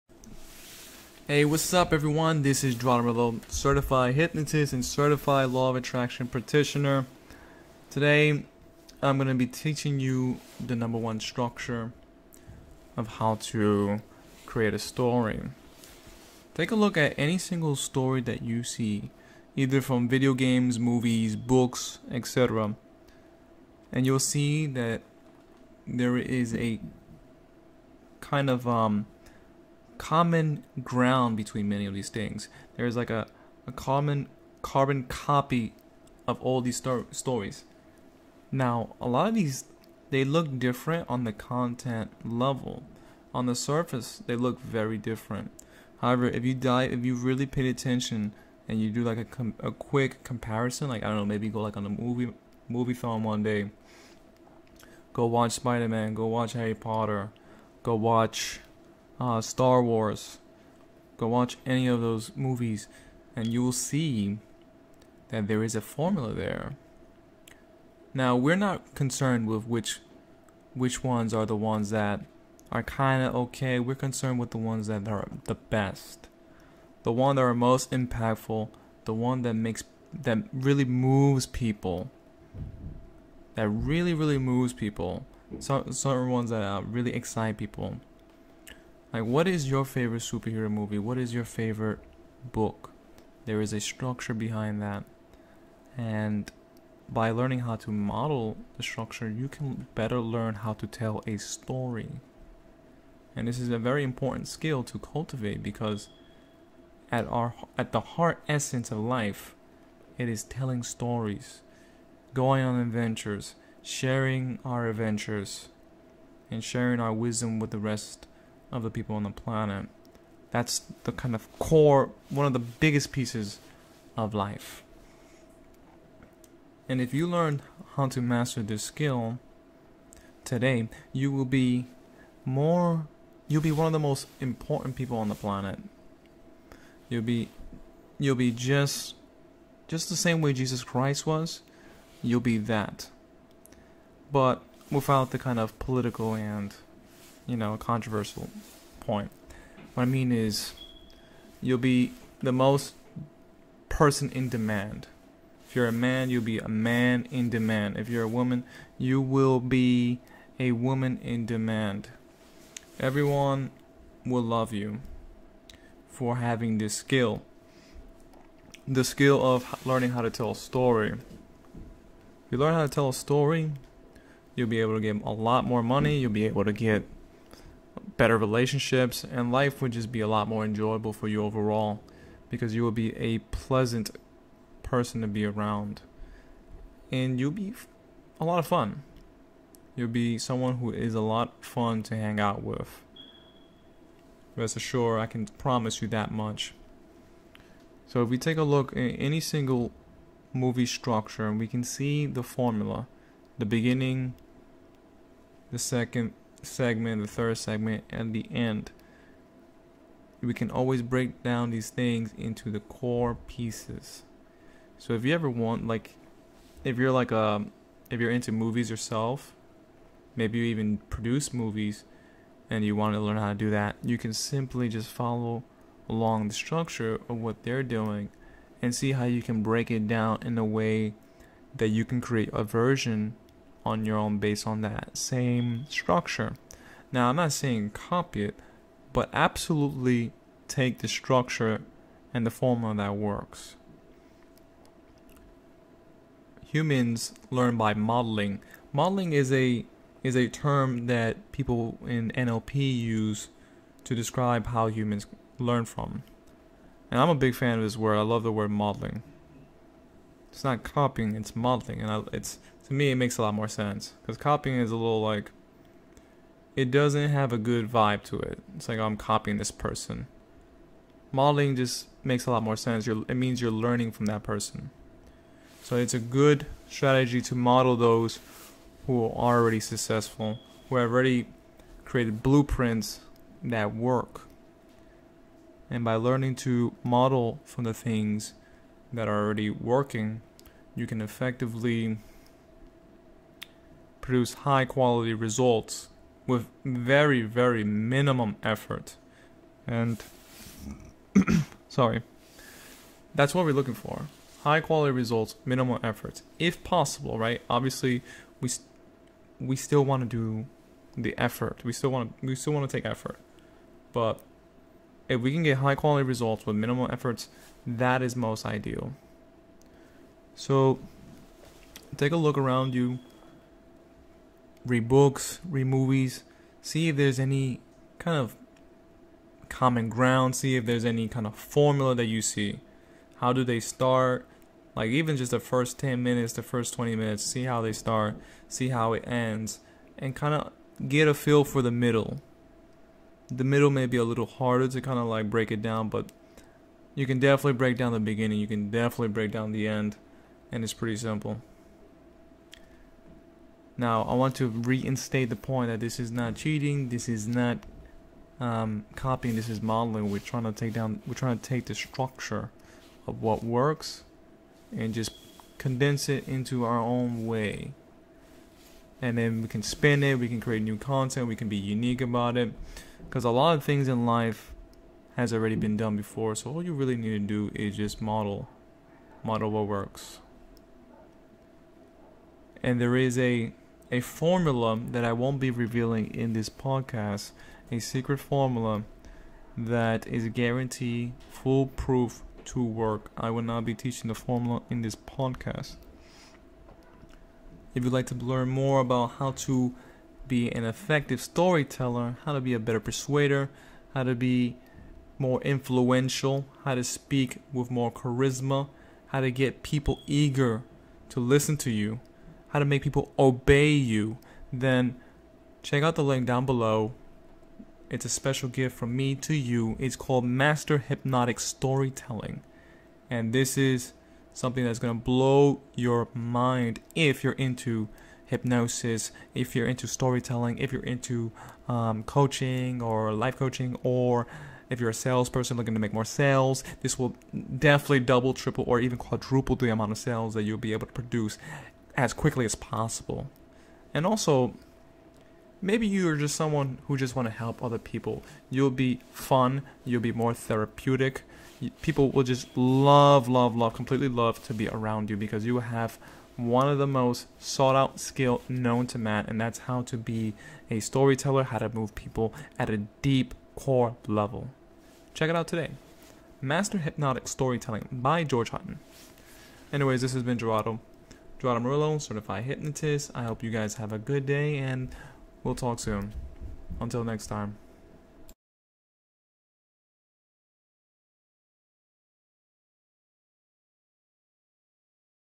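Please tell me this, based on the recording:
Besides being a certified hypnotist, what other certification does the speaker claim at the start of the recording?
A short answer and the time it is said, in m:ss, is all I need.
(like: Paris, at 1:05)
Law of attraction practitioner, at 0:04.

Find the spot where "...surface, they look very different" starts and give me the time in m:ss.
0:43.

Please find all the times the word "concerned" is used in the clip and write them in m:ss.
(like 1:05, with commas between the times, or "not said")
1:08, 1:13.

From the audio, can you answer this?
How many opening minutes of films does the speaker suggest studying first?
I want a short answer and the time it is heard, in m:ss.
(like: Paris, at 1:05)
10 or 20 minutes, at 5:35.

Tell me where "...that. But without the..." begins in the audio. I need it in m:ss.
2:22.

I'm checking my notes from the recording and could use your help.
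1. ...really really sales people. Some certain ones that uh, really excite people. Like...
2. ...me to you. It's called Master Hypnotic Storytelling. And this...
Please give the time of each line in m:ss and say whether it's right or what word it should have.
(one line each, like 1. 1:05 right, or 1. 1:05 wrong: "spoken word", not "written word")
1. 1:23 wrong: "moves", not "sales"
2. 6:59 right.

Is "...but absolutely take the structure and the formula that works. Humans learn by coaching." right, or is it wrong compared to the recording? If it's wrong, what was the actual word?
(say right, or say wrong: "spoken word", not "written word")
wrong: "modeling", not "coaching".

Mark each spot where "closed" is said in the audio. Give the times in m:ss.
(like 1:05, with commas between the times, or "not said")
not said.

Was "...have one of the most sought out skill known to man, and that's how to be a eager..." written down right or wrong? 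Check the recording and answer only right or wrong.
wrong.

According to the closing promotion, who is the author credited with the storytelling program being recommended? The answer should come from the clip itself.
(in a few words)
George Hutton.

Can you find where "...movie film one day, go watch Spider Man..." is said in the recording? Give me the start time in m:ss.
0:52.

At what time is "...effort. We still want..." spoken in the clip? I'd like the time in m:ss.
5:11.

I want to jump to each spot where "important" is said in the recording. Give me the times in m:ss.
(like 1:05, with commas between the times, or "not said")
1:44, 2:14.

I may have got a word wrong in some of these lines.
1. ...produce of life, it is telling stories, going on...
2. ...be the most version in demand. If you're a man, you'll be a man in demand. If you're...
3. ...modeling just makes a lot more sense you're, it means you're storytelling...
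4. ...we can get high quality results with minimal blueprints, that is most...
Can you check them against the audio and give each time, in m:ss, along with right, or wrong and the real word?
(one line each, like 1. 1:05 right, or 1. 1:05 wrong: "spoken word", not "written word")
1. 1:48 wrong: "essence", not "produce"
2. 2:31 wrong: "person", not "version"
3. 4:31 wrong: "learning", not "storytelling"
4. 5:15 wrong: "efforts", not "blueprints".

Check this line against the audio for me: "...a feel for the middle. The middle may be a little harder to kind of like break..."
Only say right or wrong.
right.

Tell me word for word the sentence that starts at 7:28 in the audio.
You'll be fun, you'll be more therapeutic.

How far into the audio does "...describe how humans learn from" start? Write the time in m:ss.
4:14.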